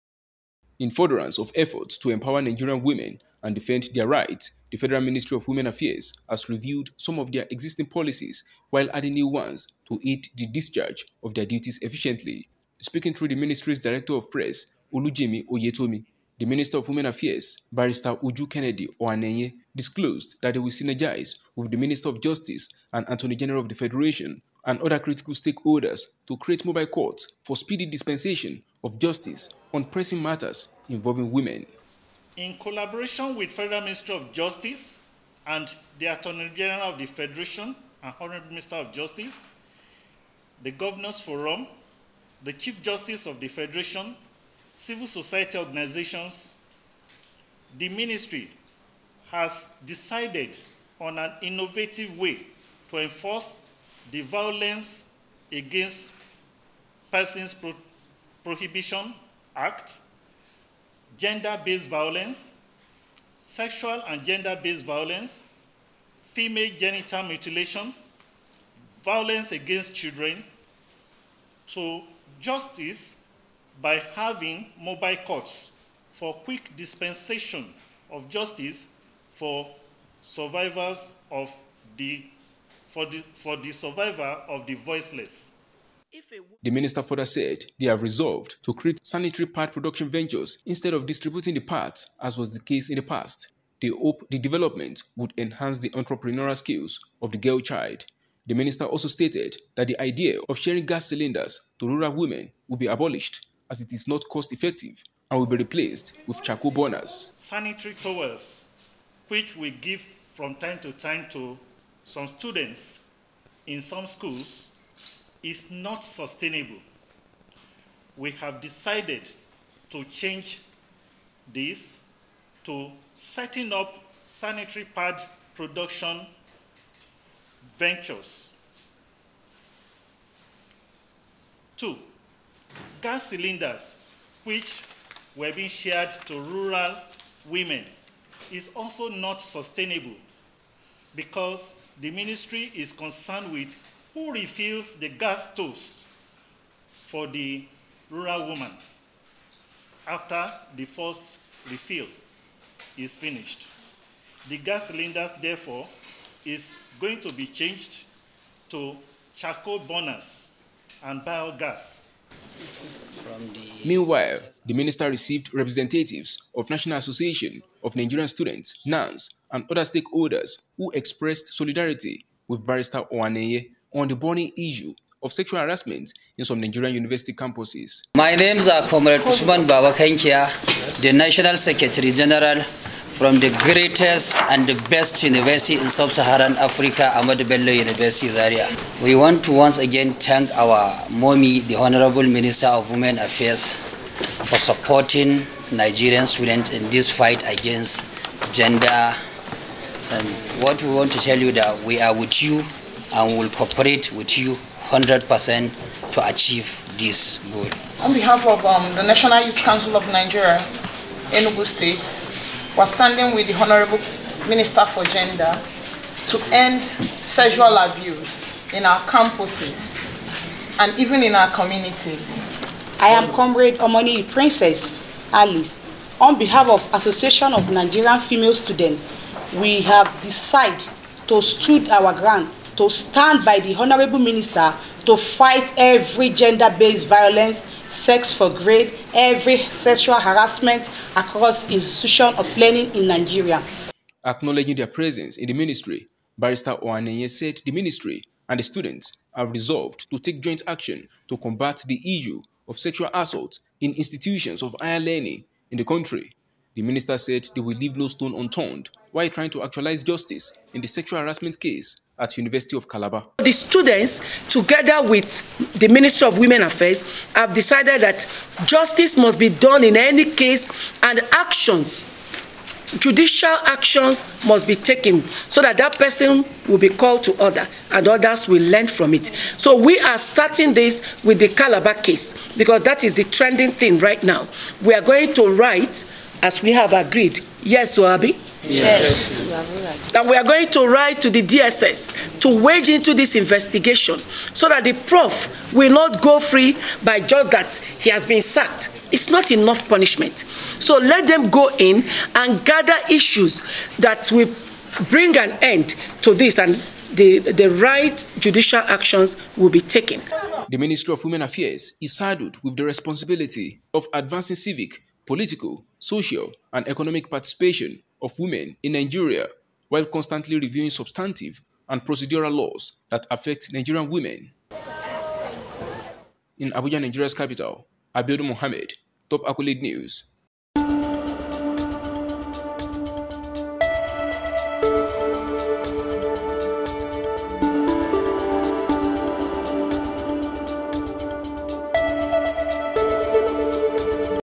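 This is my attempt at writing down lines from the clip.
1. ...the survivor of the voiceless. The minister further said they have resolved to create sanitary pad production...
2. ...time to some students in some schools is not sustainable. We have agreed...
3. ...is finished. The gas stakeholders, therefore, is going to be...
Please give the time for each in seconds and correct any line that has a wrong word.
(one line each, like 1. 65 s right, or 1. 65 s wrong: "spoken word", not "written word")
1. 83 s right
2. 110 s wrong: "decided", not "agreed"
3. 152 s wrong: "cylinders", not "stakeholders".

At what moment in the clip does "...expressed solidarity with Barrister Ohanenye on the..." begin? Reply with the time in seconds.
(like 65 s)
170 s.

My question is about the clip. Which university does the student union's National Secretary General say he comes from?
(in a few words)
Ahmadu Bello University.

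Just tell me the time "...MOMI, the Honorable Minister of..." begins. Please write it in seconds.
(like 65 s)
191 s.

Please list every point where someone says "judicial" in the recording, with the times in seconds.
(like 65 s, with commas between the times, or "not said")
272 s, 308 s.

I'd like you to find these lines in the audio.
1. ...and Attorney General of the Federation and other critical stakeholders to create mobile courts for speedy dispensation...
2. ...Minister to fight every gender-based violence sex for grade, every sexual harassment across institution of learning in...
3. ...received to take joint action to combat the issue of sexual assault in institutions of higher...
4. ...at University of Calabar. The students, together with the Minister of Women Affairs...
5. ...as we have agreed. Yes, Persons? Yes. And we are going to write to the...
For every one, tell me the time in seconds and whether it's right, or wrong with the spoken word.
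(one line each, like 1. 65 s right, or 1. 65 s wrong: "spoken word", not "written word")
1. 22 s right
2. 234 s right
3. 249 s wrong: "resolved", not "received"
4. 262 s right
5. 286 s wrong: "Wabi", not "Persons".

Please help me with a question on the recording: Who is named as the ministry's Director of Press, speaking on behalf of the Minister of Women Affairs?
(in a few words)
Olujimi Oyetomi.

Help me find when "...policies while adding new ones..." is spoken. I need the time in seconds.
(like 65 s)
7 s.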